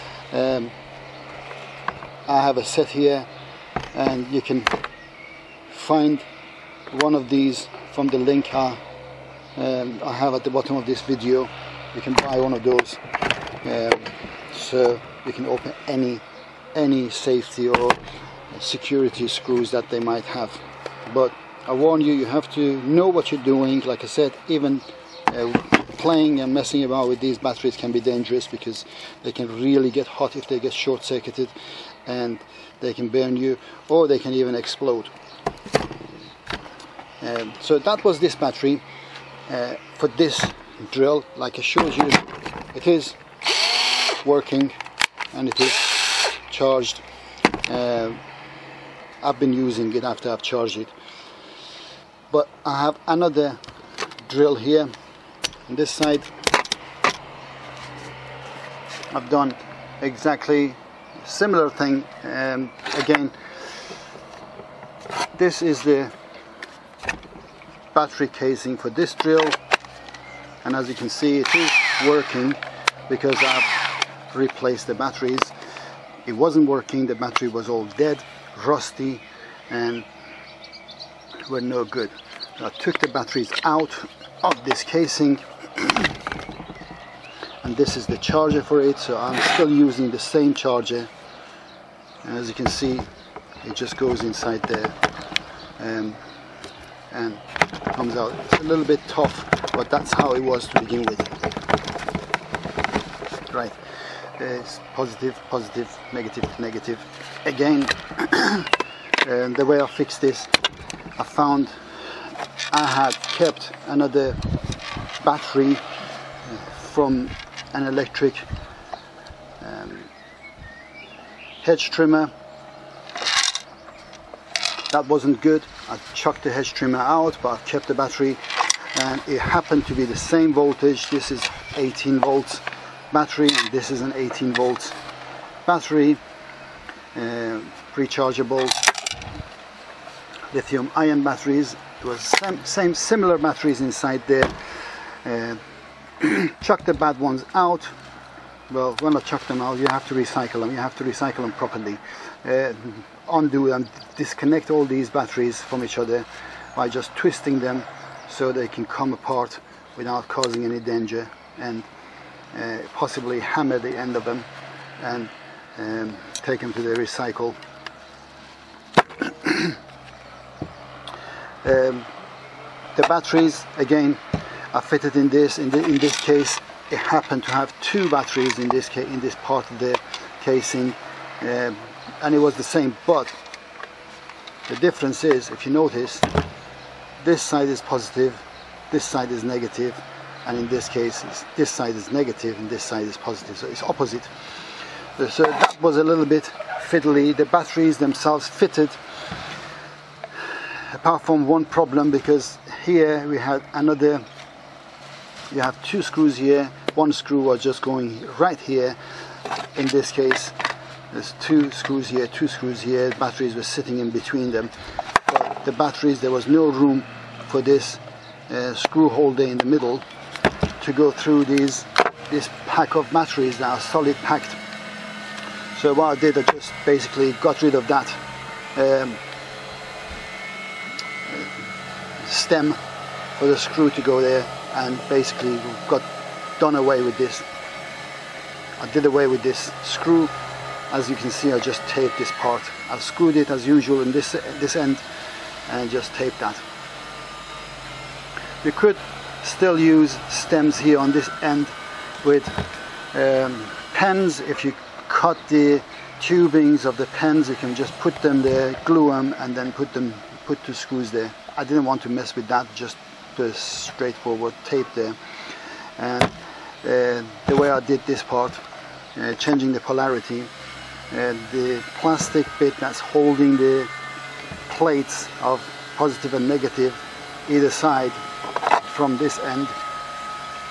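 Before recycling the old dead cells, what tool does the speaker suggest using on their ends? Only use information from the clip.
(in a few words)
hammer.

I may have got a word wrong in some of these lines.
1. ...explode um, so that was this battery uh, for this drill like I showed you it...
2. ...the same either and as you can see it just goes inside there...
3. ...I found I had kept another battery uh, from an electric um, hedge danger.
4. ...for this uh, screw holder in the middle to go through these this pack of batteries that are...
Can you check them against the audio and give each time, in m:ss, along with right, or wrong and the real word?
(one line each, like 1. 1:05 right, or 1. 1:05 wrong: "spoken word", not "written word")
1. 0:34 right
2. 1:30 wrong: "charger", not "either"
3. 1:51 wrong: "trimmer", not "danger"
4. 3:37 right.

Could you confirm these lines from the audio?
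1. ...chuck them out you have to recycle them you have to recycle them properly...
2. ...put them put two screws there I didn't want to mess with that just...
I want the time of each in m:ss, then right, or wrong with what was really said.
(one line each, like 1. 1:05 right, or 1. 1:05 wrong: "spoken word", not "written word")
1. 2:29 right
2. 4:19 right.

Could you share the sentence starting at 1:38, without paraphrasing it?
It's a little bit tough, but that's how it was to begin with.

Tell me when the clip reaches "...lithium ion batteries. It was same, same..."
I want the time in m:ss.
2:20.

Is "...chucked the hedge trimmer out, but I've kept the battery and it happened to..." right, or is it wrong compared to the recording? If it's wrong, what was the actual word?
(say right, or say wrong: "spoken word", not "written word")
right.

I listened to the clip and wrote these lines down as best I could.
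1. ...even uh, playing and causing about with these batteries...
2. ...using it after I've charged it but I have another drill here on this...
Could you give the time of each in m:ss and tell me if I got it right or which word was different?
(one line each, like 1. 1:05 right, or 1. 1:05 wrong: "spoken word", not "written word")
1. 0:24 wrong: "messing", not "causing"
2. 0:49 right.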